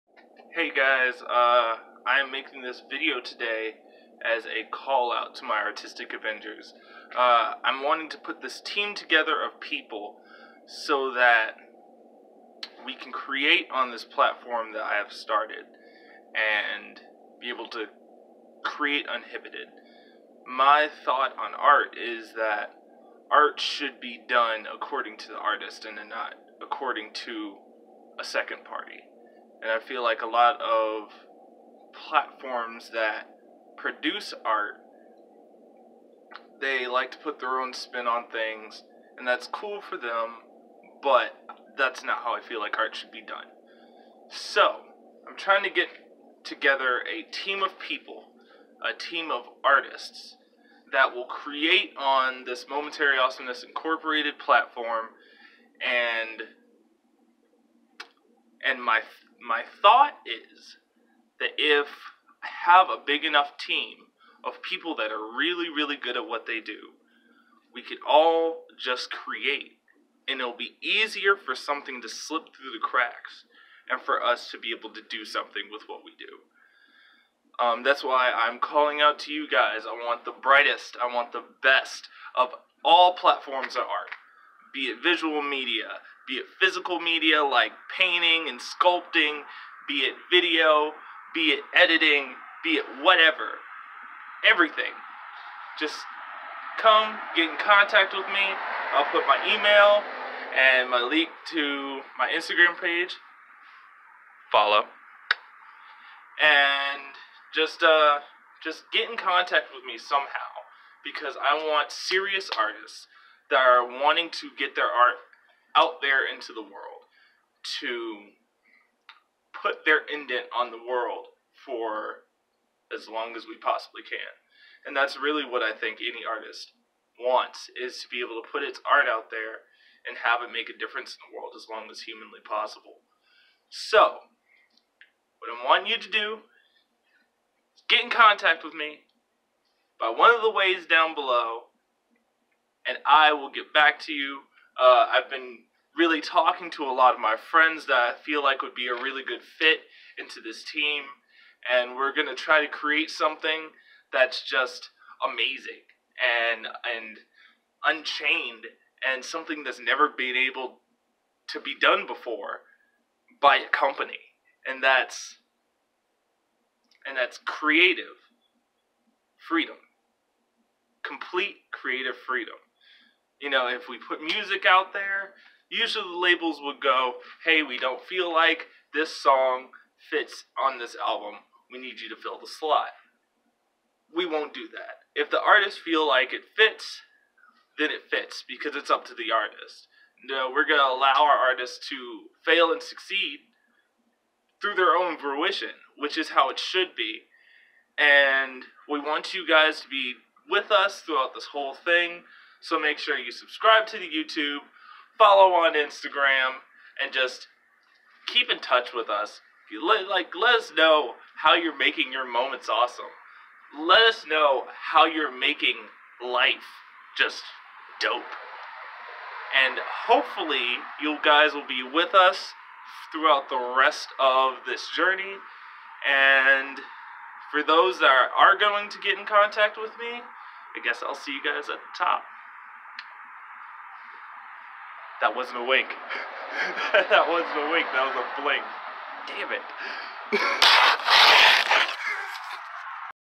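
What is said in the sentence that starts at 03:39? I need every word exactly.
And hopefully, you guys will be with us throughout the rest of this journey.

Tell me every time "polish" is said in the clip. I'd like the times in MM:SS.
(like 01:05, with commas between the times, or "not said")
not said.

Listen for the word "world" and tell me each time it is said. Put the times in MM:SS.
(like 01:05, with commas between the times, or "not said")
01:56, 02:00, 02:11.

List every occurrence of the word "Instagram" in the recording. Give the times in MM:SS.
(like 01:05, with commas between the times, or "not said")
01:42, 03:25.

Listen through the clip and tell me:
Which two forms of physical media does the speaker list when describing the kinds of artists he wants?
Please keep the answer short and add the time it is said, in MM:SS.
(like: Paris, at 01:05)
painting and sculpting, at 01:27.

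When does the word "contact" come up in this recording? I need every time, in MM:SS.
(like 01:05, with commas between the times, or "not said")
01:37, 01:49, 02:18, 03:49.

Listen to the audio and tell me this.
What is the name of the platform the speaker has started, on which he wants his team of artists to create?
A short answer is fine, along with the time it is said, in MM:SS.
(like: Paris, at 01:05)
Momentary Awesomeness Incorporated, at 00:52.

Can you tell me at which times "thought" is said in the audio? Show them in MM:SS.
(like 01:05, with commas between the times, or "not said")
00:21, 00:59.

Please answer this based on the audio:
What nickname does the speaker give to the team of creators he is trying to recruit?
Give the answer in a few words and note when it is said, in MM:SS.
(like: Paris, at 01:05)
Artistic Avengers, at 00:05.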